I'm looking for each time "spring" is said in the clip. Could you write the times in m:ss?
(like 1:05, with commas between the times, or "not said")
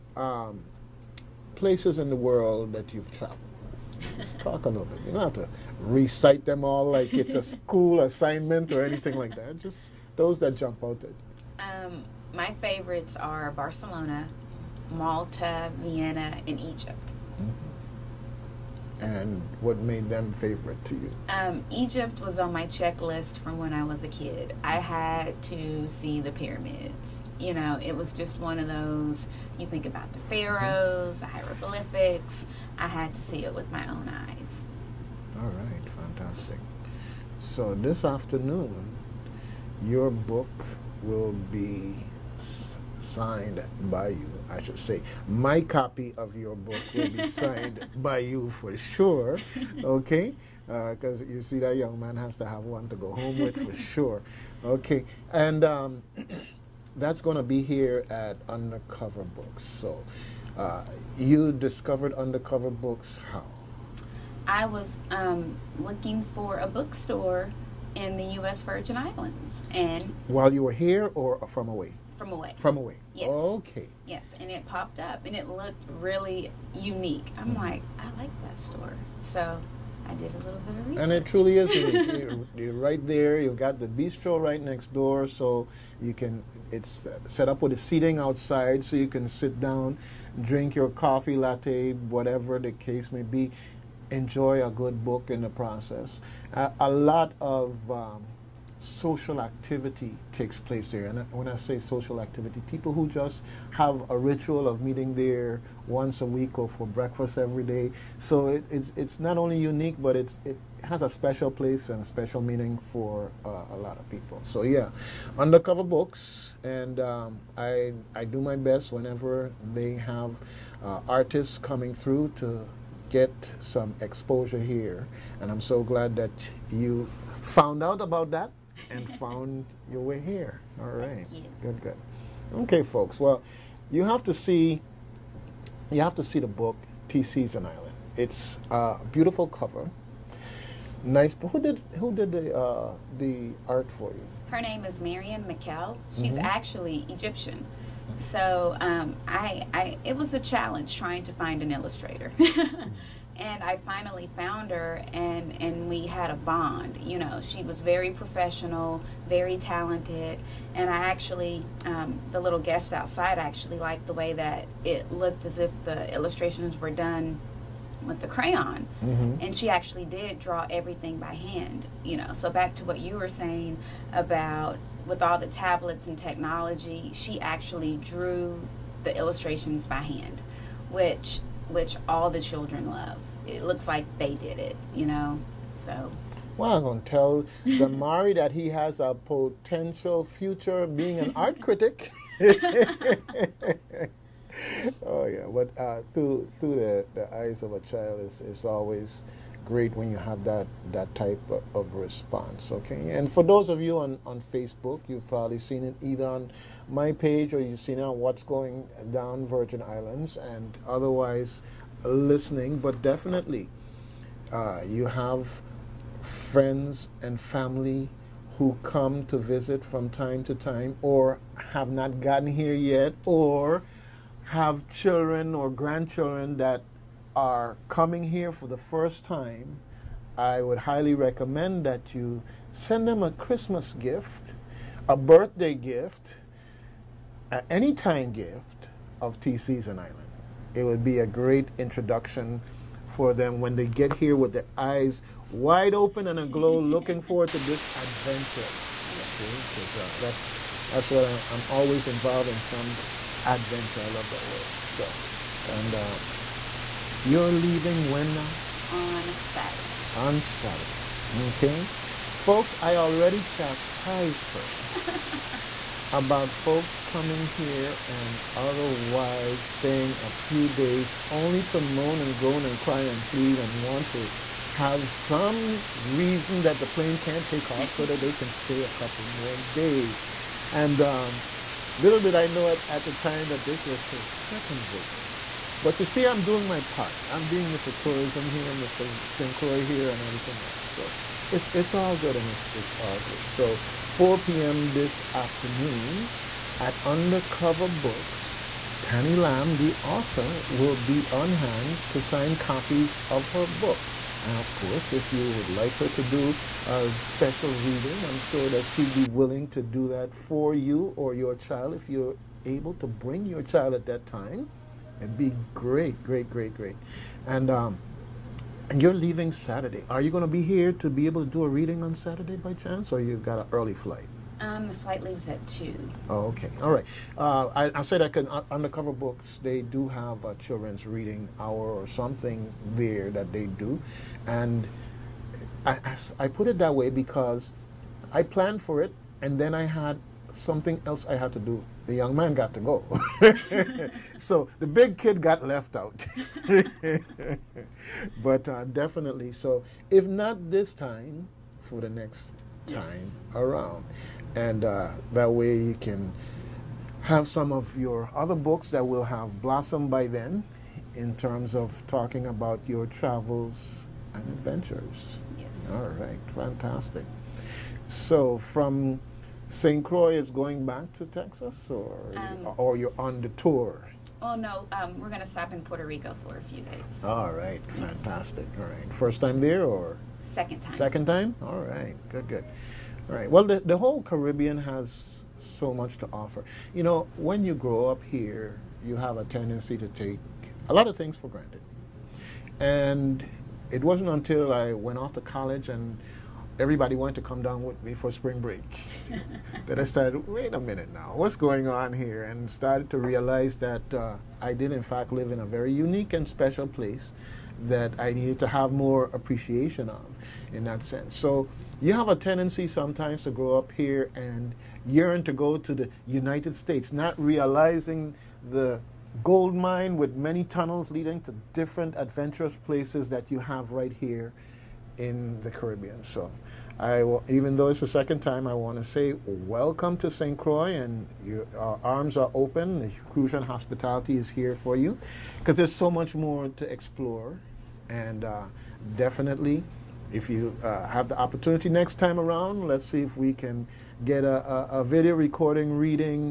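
6:38.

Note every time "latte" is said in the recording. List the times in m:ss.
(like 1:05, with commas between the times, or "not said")
1:31.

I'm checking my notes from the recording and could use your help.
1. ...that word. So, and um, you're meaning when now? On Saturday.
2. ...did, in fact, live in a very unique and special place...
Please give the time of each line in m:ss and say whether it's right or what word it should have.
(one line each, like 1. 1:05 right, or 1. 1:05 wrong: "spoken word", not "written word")
1. 4:14 wrong: "leaving", not "meaning"
2. 6:44 right.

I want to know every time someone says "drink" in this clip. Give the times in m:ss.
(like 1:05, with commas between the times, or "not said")
1:30.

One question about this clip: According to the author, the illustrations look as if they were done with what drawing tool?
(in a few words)
crayon.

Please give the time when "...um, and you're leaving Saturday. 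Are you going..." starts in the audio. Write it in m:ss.
5:17.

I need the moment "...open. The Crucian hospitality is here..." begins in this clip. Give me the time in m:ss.
7:12.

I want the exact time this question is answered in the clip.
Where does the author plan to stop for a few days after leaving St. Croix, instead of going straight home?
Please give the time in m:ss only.
6:15.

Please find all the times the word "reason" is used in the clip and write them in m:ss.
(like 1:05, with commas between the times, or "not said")
4:35.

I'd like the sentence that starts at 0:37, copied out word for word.
So this afternoon, your book will be signed by you, I should say.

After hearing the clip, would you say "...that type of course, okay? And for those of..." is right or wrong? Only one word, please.
wrong.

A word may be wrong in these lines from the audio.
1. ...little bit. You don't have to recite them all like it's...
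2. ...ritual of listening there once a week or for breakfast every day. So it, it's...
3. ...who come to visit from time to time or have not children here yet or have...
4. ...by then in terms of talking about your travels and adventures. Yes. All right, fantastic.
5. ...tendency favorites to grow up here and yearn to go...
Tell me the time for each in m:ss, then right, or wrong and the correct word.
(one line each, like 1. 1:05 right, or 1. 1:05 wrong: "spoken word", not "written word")
1. 0:04 right
2. 1:44 wrong: "meeting", not "listening"
3. 3:38 wrong: "gotten", not "children"
4. 6:00 right
5. 6:52 wrong: "sometimes", not "favorites".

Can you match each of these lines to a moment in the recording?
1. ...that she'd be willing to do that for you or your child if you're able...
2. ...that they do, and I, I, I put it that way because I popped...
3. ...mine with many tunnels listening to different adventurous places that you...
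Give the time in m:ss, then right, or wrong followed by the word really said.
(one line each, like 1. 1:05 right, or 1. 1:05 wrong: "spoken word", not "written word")
1. 5:08 right
2. 5:33 wrong: "planned", not "popped"
3. 6:59 wrong: "leading", not "listening".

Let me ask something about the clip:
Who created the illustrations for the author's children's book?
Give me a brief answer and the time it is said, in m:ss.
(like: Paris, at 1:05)
Marian Mekhail, at 2:25.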